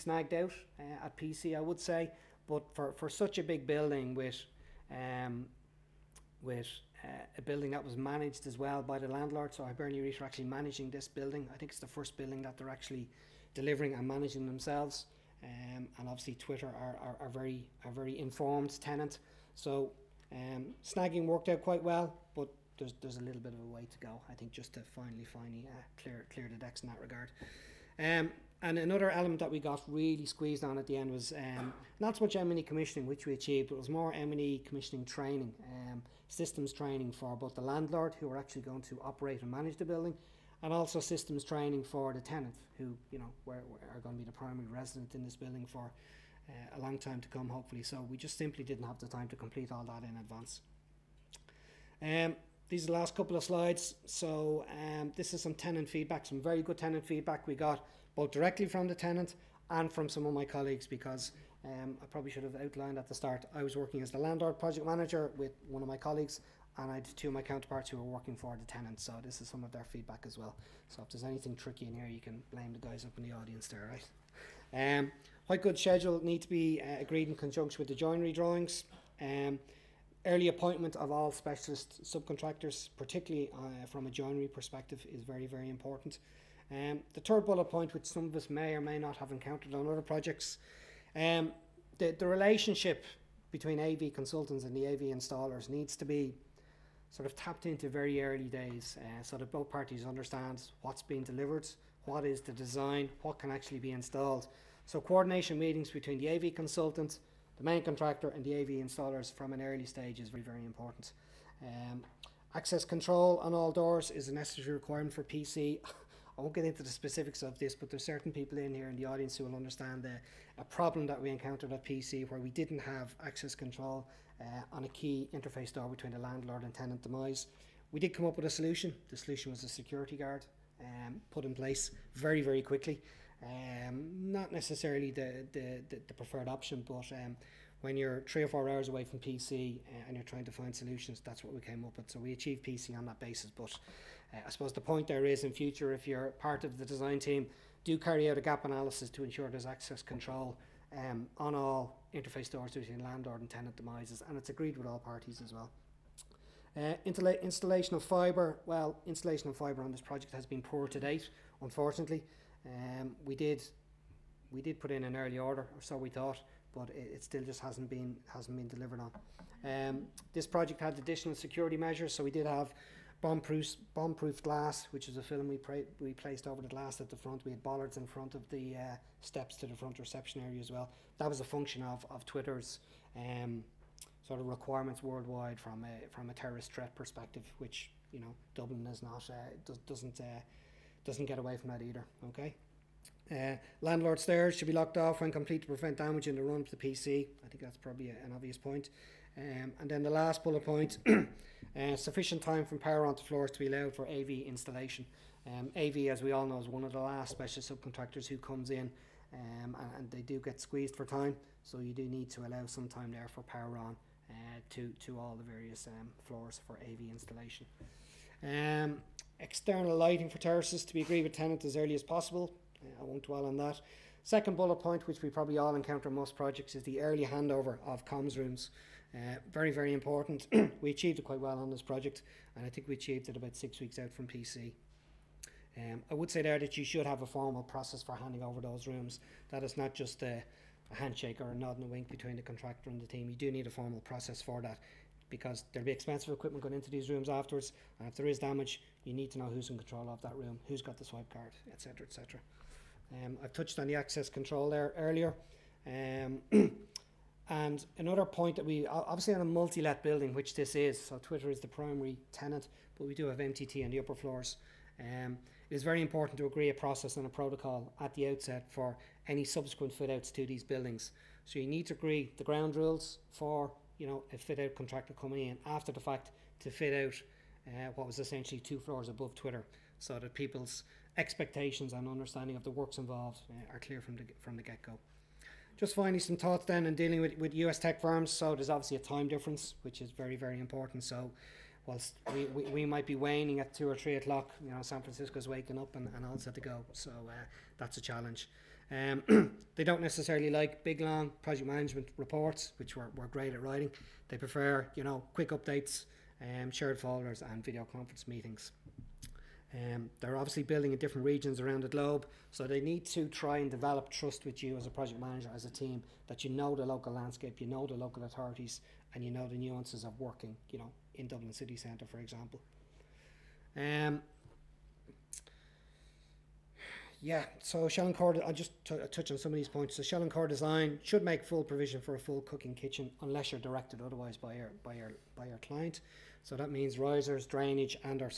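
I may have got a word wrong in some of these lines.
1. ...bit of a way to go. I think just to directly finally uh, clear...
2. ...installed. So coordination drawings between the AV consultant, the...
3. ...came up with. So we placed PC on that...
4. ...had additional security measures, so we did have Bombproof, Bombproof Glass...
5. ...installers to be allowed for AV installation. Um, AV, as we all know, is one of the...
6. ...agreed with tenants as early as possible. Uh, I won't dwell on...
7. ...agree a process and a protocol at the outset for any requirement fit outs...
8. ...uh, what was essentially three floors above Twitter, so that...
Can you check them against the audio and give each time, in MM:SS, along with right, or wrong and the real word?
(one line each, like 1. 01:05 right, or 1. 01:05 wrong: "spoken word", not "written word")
1. 00:23 wrong: "finally", not "directly"
2. 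01:43 wrong: "meetings", not "drawings"
3. 02:21 wrong: "achieved", not "placed"
4. 02:50 right
5. 03:23 wrong: "floors", not "installers"
6. 03:41 right
7. 04:26 wrong: "subsequent", not "requirement"
8. 04:37 wrong: "two", not "three".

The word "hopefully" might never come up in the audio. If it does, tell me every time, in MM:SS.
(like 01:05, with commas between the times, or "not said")
00:47.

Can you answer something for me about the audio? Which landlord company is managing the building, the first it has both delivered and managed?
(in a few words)
Hibernia REIT.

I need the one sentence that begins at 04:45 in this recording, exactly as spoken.
Just finally, some thoughts then on dealing with, with US tech firms.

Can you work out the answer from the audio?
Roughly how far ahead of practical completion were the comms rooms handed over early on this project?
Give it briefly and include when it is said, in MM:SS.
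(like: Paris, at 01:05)
6 weeks, at 03:53.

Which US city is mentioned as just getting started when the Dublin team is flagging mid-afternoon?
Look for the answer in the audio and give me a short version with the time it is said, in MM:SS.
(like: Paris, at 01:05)
San Francisco, at 04:54.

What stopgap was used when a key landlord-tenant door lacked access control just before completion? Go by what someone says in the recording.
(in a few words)
A security guard.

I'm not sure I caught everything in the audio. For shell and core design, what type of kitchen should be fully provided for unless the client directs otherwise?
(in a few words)
Full cooking kitchen.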